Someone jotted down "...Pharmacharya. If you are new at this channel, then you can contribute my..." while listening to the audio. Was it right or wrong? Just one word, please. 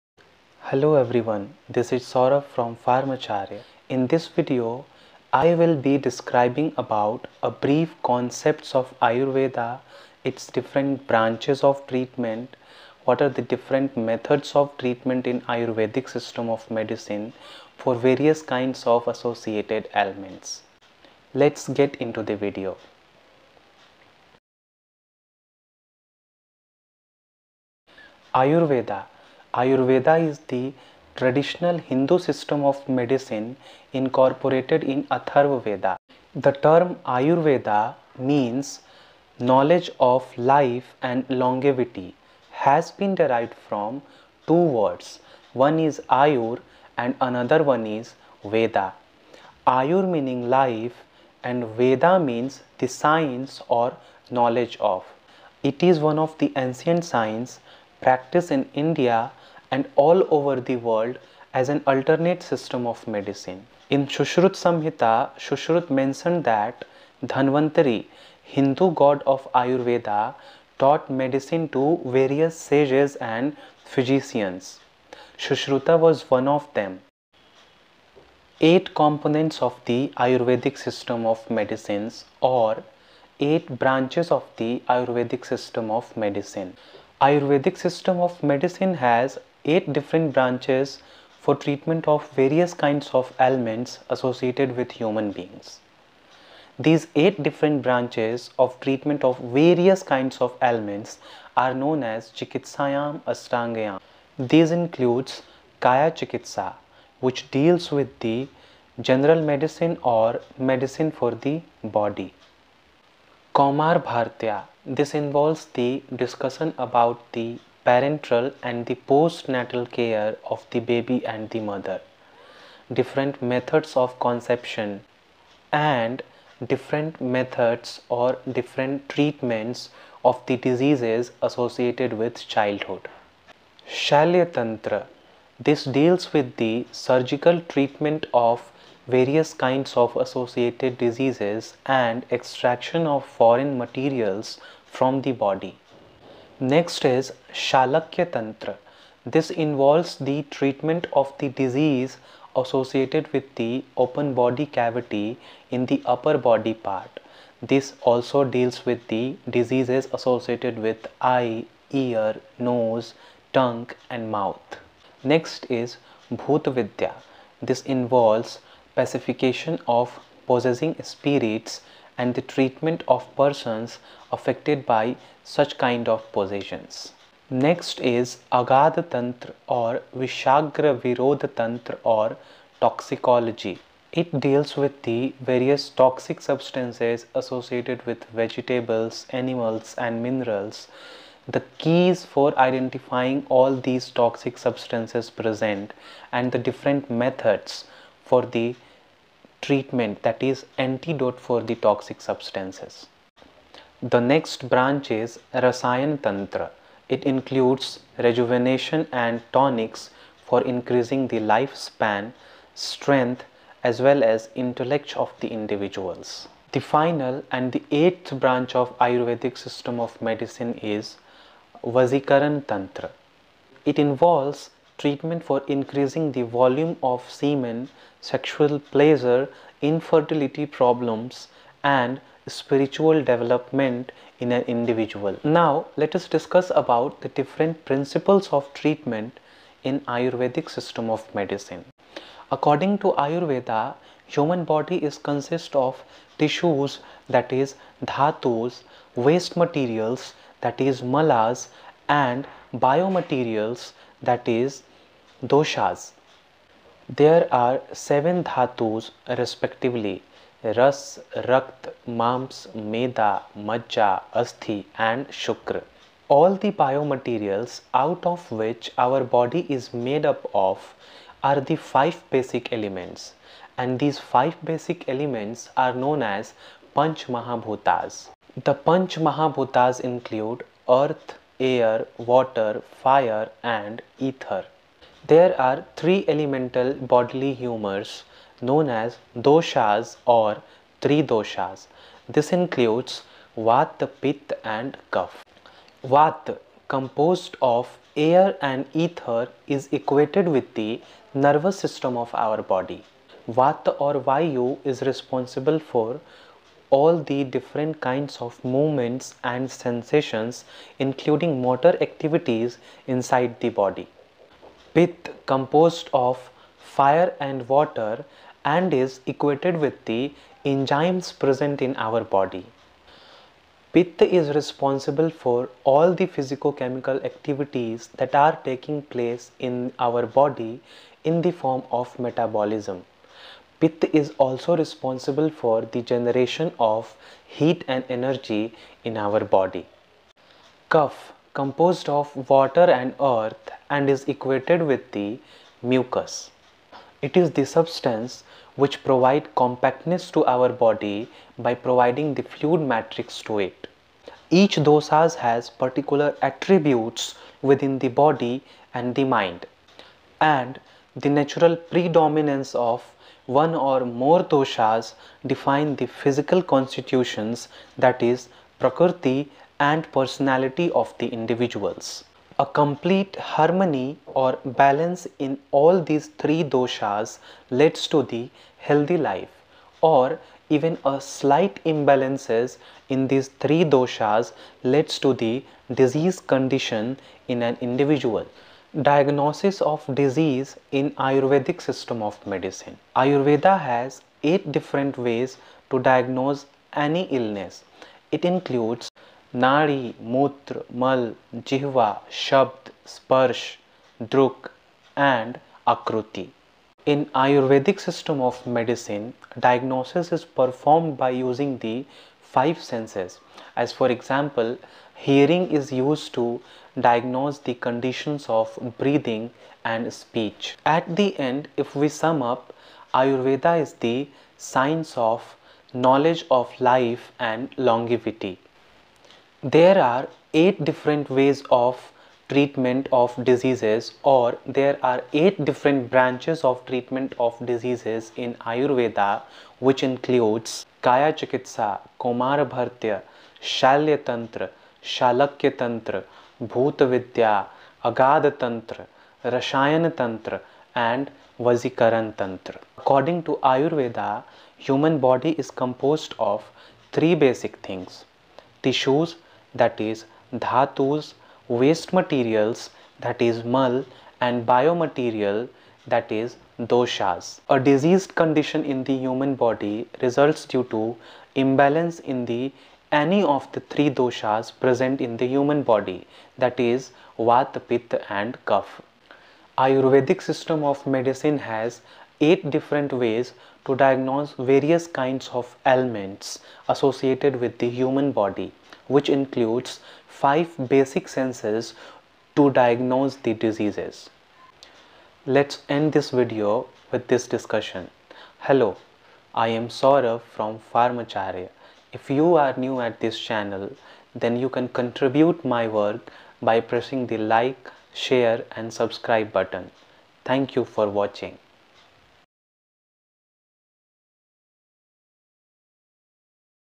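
right.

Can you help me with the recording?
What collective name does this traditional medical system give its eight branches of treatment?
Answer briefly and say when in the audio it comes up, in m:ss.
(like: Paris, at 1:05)
Chikitsayam Astangayam, at 1:42.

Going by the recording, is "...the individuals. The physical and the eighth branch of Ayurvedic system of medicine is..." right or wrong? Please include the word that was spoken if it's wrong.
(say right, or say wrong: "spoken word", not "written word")
wrong: "final", not "physical".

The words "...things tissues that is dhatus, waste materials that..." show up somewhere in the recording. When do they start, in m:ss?
7:37.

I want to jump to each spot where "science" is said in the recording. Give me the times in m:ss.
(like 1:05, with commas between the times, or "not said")
0:52, 0:57, 7:04.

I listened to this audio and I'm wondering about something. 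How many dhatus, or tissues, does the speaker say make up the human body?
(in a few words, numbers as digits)
7.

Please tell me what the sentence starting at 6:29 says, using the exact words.
Diagnosis of disease in Ayurvedic system of medicine.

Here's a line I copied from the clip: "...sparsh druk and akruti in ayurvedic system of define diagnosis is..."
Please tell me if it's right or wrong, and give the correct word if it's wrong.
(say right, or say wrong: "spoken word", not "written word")
wrong: "medicine", not "define".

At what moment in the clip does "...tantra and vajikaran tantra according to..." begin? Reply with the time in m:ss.
7:30.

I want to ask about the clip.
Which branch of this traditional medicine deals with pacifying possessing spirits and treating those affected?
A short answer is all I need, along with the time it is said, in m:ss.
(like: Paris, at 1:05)
Bhutvidya, at 2:46.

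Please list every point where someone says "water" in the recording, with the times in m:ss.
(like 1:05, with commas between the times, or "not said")
4:42, 5:17, 5:42.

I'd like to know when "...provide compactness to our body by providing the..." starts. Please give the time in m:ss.
5:49.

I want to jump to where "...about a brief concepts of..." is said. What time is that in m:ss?
0:06.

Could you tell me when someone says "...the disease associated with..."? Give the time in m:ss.
2:31.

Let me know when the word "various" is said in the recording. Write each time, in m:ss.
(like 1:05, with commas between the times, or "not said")
0:17, 1:12, 1:32, 1:39, 2:19, 3:05, 8:04.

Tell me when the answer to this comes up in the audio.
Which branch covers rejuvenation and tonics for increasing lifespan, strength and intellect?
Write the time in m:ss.
3:25.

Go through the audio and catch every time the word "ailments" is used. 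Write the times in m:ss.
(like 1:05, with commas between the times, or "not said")
0:19, 1:33, 1:40, 8:05.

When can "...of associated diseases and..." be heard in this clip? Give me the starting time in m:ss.
2:19.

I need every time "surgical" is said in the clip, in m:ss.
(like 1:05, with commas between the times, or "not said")
2:16.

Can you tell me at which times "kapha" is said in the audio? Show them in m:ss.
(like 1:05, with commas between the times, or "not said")
4:55, 7:58.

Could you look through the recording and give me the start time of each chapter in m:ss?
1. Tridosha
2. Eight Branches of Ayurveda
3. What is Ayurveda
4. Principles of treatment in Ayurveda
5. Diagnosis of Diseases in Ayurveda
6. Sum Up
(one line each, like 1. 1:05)
1. 4:45
2. 1:18
3. 0:28
4. 3:55
5. 6:28
6. 7:00.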